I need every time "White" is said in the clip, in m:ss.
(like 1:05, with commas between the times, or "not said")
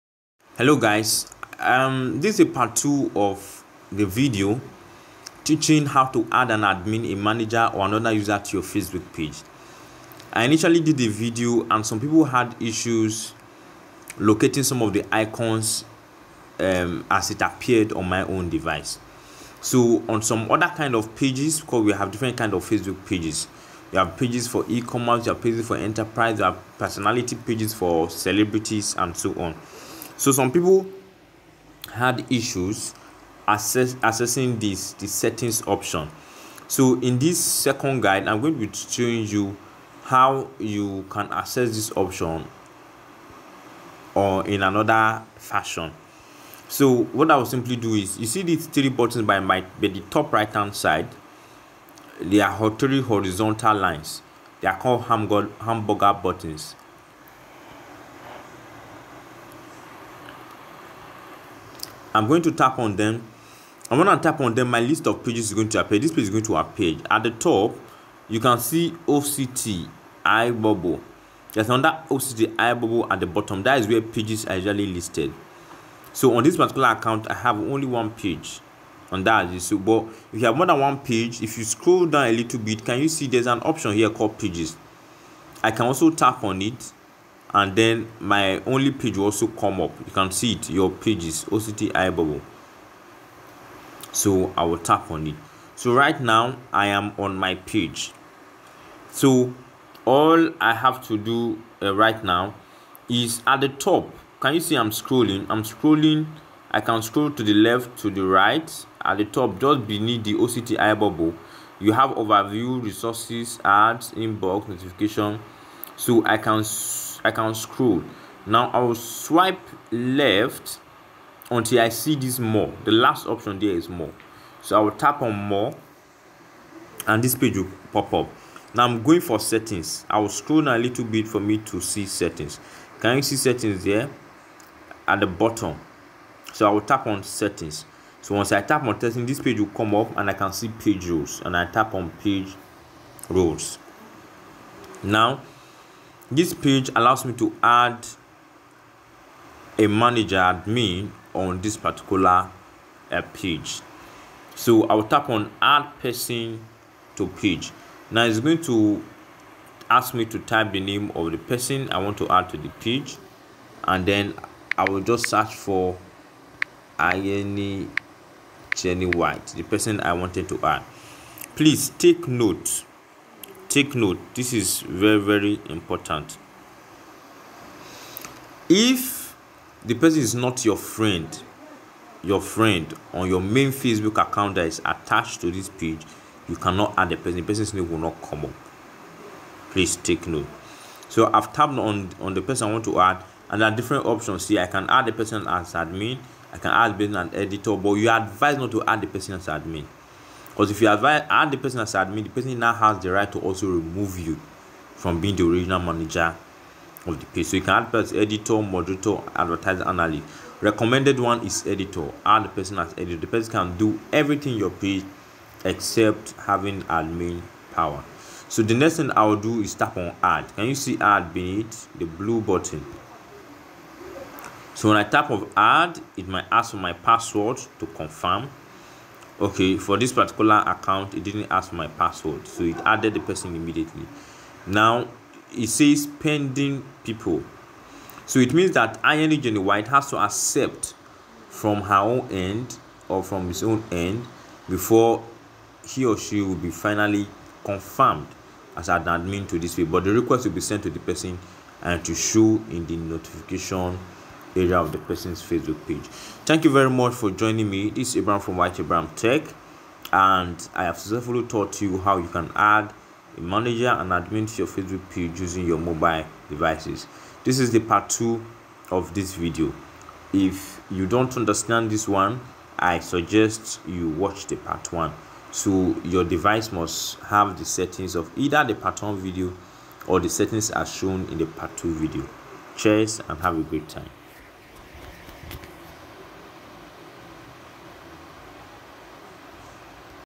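2:49, 3:59.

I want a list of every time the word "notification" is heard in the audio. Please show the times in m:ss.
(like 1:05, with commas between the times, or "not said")
1:54, 4:12.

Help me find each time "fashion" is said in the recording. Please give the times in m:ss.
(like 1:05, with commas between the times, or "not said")
0:45.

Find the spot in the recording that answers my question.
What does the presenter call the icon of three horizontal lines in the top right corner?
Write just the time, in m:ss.
0:55.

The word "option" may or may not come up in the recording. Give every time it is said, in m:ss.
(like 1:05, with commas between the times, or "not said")
0:35, 0:41, 1:23, 2:03, 3:14.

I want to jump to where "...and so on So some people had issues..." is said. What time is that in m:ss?
0:28.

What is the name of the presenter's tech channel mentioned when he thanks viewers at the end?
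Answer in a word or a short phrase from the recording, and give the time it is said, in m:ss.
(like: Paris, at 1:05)
Whyte Abraham Tech, at 4:18.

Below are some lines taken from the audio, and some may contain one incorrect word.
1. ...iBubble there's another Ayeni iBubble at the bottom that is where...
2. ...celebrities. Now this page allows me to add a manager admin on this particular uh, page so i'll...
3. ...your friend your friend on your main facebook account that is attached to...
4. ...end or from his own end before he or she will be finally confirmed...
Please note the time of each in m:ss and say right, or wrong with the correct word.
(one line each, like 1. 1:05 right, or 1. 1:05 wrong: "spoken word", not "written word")
1. 1:10 wrong: "OCT", not "Ayeni"
2. 2:23 wrong: "roles", not "celebrities"
3. 3:00 right
4. 4:02 right.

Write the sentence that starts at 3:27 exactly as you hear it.
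So you can add as editor, moderator, advertiser, analyst.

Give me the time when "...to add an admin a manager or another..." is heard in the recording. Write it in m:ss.
0:06.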